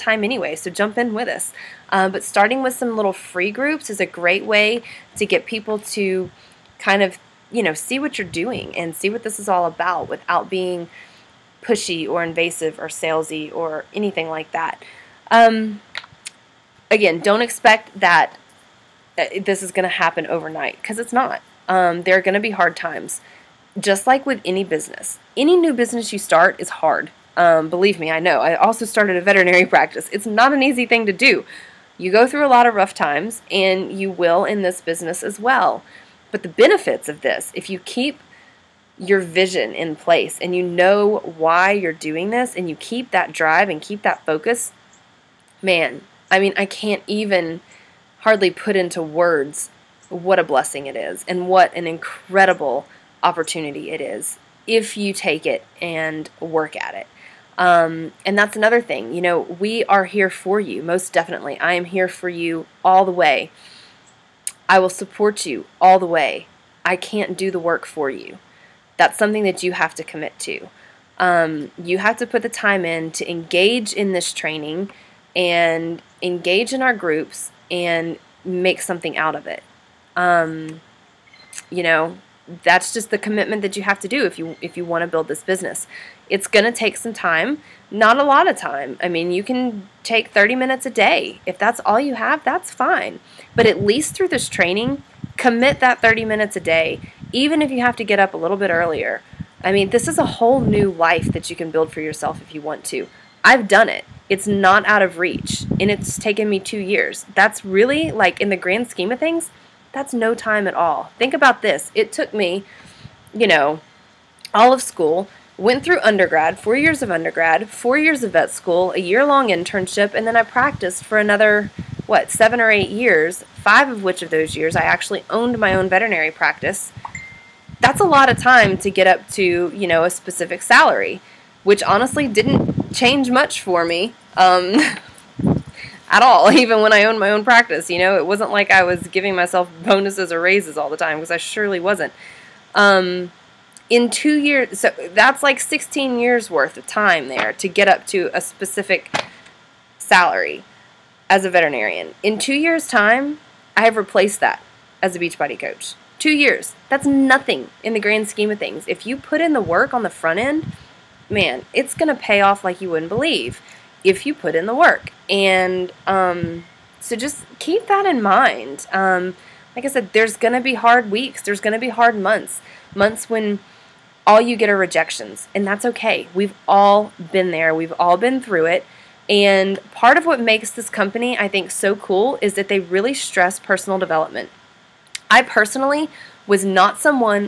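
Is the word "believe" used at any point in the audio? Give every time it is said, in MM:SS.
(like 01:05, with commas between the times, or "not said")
00:27, 02:43.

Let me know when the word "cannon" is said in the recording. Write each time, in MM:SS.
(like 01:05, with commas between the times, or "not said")
not said.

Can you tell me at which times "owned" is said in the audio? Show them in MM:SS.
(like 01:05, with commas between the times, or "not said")
02:05, 02:17.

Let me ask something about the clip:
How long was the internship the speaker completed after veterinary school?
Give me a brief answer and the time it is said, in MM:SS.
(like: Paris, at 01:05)
a year, at 01:58.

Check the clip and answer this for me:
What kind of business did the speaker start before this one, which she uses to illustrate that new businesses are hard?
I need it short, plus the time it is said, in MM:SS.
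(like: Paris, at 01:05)
veterinary practice, at 00:29.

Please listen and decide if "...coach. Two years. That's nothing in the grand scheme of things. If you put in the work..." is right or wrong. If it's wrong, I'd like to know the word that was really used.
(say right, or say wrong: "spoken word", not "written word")
right.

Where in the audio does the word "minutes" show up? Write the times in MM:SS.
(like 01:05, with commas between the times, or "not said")
01:30, 01:36.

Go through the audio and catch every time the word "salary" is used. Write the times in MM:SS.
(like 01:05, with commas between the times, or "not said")
02:10, 02:29.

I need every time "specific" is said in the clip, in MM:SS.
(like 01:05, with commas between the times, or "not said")
02:10, 02:28.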